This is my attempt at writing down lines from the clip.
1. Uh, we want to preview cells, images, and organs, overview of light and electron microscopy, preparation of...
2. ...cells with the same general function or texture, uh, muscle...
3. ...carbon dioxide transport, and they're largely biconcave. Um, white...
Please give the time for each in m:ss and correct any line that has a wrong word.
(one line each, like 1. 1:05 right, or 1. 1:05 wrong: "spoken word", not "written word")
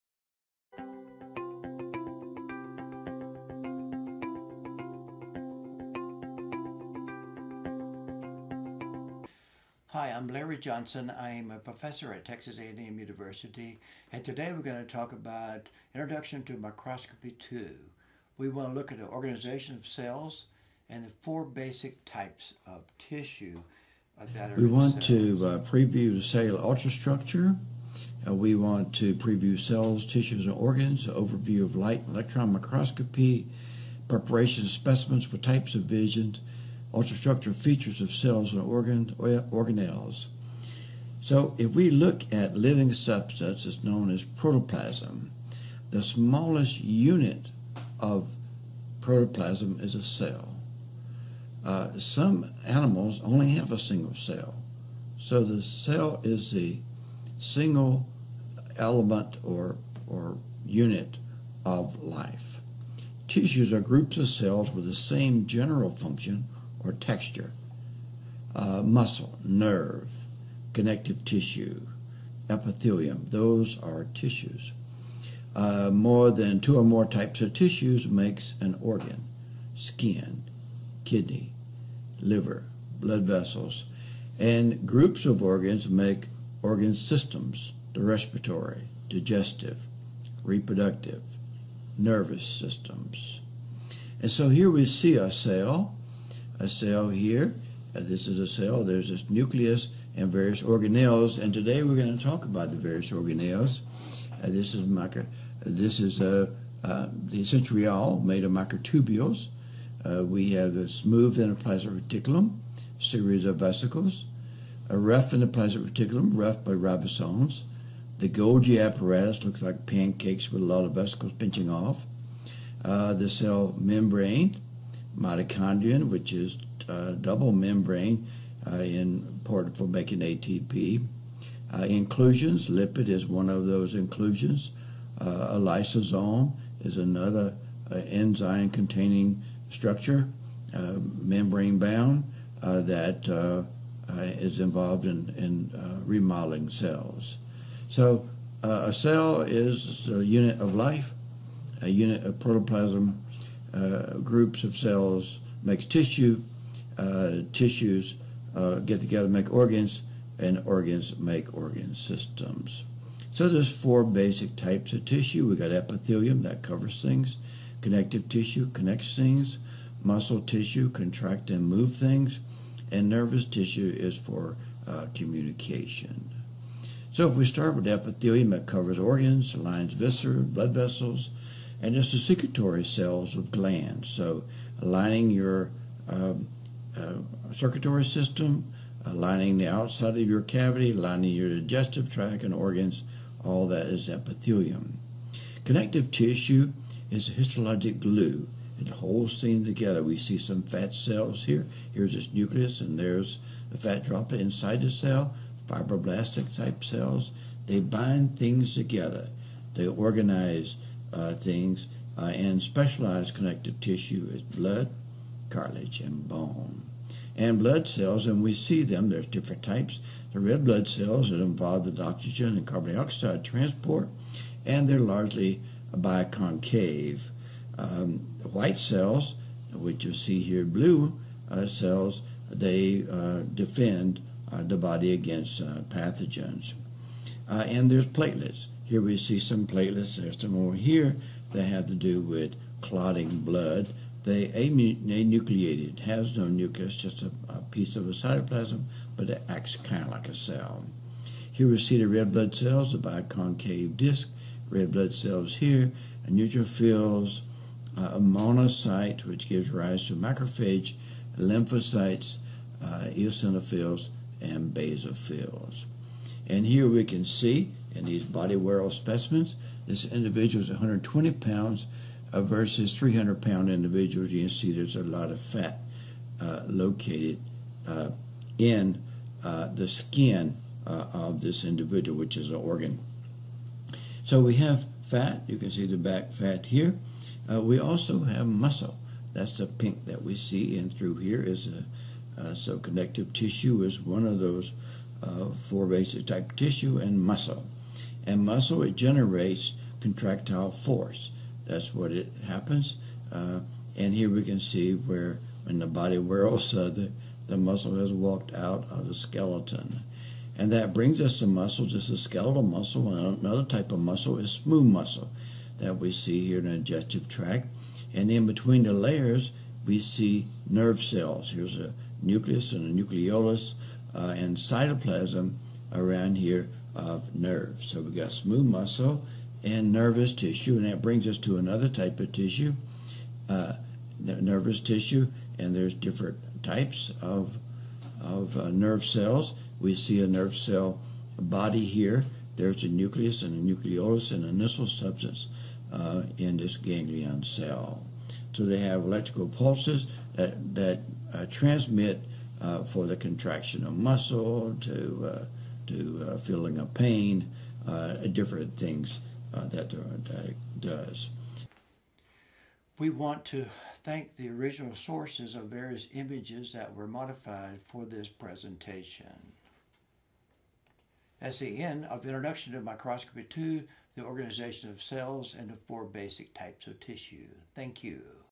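1. 0:28 wrong: "tissues", not "images"
2. 1:04 right
3. 3:42 right.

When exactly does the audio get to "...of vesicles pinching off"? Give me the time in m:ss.
2:00.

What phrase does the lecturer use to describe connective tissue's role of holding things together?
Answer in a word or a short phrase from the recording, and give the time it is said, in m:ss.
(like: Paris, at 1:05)
histologic glue, at 3:17.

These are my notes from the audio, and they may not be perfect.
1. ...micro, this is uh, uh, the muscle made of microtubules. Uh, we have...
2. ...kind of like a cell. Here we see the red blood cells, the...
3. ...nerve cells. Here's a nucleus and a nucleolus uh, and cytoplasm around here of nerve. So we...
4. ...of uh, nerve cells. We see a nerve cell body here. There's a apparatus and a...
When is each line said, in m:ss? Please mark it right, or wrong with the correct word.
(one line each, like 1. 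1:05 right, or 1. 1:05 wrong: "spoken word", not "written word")
1. 1:44 wrong: "centriole", not "muscle"
2. 4:09 right
3. 5:20 right
4. 5:38 wrong: "nucleus", not "apparatus".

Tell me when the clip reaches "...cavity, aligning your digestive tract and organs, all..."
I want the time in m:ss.
3:10.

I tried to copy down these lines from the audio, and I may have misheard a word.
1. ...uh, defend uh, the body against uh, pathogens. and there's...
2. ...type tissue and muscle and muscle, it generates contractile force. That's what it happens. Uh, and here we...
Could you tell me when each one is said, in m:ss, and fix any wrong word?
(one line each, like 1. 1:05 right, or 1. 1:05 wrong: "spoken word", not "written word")
1. 3:53 right
2. 4:56 right.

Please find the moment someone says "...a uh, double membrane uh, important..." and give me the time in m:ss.
2:06.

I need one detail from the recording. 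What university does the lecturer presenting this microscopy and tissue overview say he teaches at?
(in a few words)
Texas A&M University.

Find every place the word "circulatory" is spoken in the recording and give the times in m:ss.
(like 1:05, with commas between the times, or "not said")
3:02, 3:07.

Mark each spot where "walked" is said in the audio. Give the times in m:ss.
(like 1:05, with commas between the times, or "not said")
5:08.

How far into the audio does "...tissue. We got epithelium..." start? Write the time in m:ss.
2:45.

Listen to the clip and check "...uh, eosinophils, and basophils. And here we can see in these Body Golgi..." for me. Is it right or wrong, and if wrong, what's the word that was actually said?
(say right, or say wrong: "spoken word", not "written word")
wrong: "World", not "Golgi".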